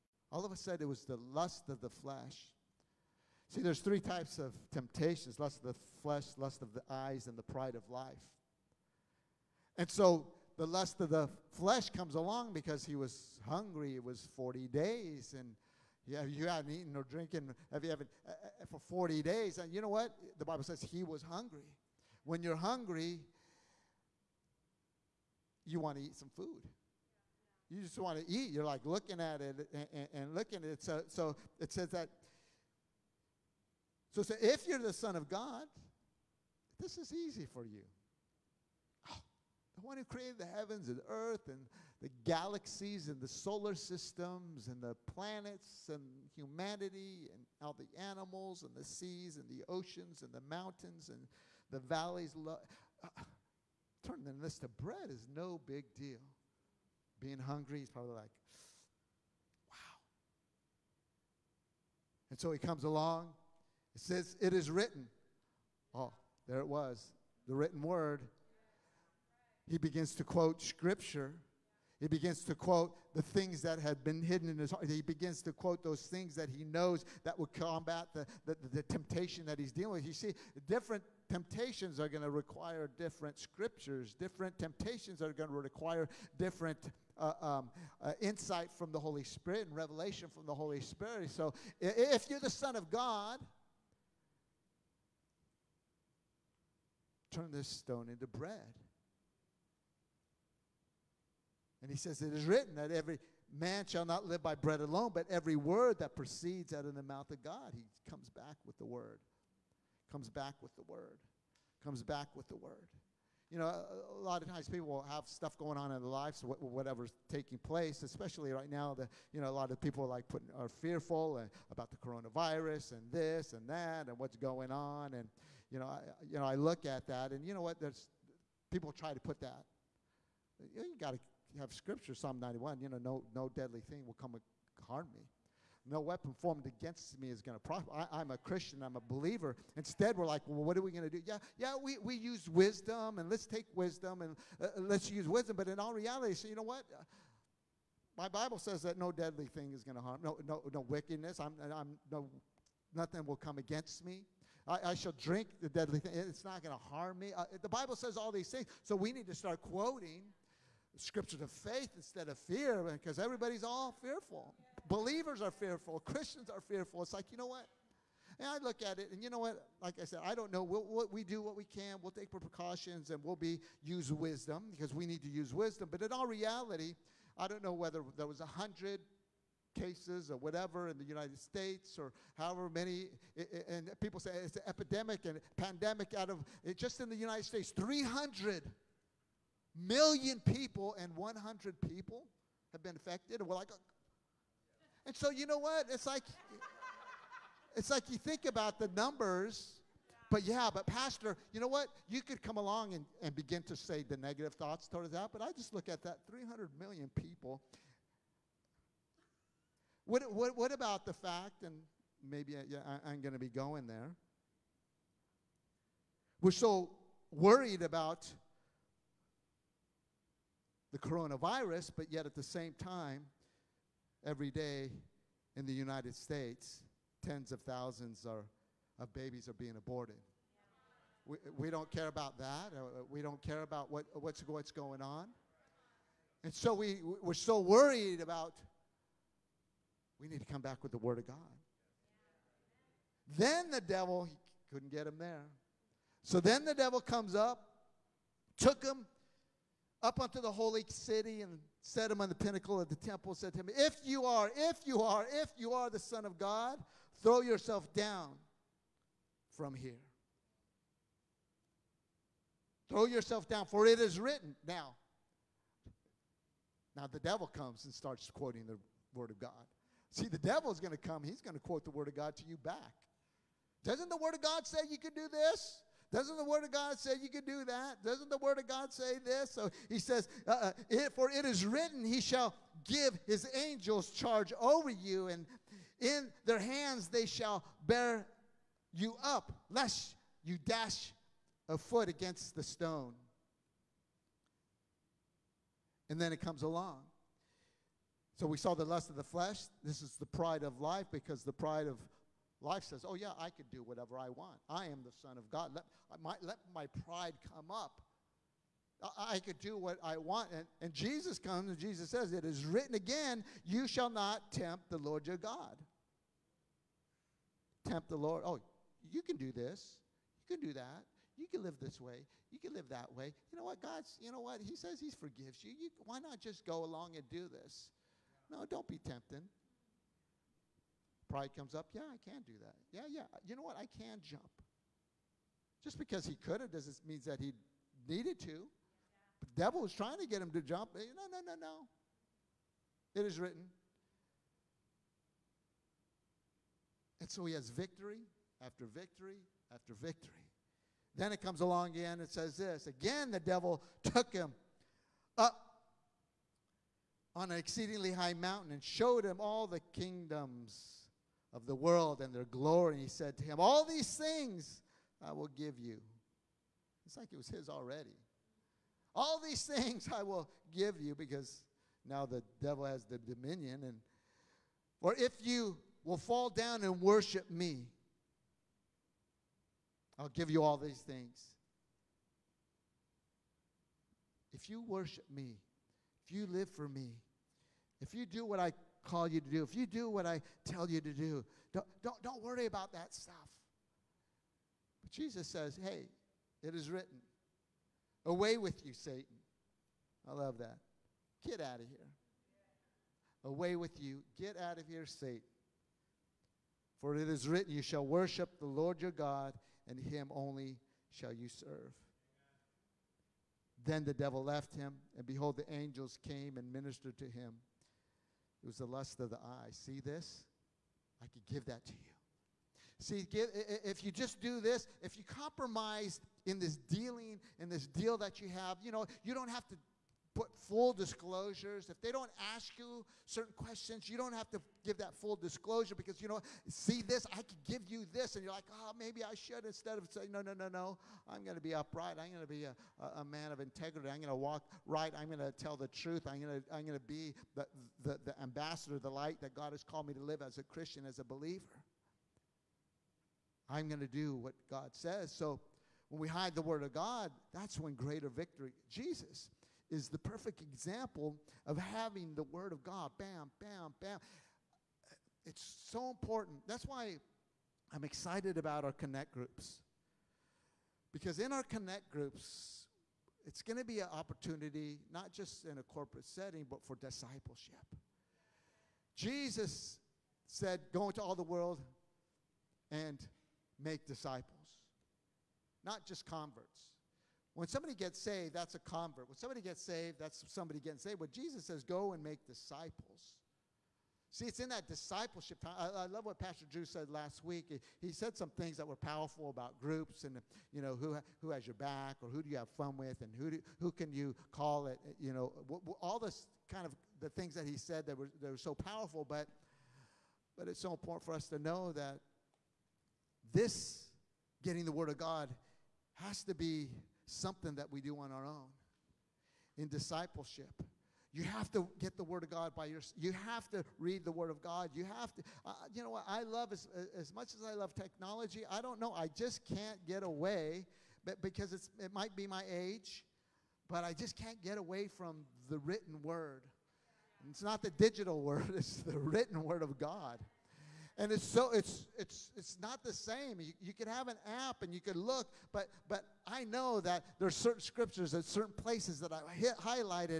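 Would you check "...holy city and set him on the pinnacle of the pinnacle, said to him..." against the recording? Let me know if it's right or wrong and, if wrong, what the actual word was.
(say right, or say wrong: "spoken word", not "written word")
wrong: "temple", not "pinnacle".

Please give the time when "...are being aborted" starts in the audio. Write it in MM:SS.
03:49.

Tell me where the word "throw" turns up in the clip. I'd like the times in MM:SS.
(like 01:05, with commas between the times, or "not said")
04:17, 04:22.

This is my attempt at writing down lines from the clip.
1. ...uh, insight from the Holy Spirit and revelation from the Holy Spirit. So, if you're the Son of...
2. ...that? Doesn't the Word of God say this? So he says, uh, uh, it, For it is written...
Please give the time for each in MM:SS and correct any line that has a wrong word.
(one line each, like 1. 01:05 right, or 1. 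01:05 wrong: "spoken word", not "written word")
1. 01:28 right
2. 04:37 right.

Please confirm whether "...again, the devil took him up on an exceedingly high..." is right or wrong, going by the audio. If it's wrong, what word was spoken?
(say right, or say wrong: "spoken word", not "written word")
right.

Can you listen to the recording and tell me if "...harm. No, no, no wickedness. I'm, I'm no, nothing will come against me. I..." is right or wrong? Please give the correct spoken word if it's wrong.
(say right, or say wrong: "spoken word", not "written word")
right.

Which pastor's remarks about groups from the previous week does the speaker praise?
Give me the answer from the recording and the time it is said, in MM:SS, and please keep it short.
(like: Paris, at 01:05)
Pastor Drew, at 08:16.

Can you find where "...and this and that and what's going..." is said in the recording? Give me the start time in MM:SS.
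02:02.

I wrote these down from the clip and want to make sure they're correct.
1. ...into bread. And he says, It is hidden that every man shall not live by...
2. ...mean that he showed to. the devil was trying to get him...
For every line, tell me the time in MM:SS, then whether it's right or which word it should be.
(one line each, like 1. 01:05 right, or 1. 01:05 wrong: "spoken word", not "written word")
1. 01:38 wrong: "written", not "hidden"
2. 05:37 wrong: "needed", not "showed".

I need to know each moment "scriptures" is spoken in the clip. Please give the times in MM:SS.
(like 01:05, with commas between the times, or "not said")
01:10, 01:23, 02:11, 02:40, 09:07.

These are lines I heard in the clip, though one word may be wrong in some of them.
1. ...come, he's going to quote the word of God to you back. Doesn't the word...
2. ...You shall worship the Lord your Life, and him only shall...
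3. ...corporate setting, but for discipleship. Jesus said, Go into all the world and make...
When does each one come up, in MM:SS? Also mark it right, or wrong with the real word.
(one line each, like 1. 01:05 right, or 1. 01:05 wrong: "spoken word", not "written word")
1. 04:30 right
2. 06:47 wrong: "God", not "Life"
3. 07:55 right.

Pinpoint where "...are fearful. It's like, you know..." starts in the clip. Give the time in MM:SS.
02:46.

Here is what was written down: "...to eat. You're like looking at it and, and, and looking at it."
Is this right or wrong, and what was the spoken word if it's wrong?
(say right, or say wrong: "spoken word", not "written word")
right.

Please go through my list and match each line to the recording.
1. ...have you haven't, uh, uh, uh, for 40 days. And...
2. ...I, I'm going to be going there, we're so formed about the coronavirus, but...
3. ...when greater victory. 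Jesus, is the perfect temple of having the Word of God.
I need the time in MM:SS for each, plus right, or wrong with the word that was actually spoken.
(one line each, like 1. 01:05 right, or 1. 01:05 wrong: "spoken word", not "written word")
1. 00:17 right
2. 03:33 wrong: "worried", not "formed"
3. 07:37 wrong: "example", not "temple".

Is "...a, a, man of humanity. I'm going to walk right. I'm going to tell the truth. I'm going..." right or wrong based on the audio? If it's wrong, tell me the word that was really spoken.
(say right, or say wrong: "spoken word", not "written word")
wrong: "integrity", not "humanity".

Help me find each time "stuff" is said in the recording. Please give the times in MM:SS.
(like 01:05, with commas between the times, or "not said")
01:55, 06:33.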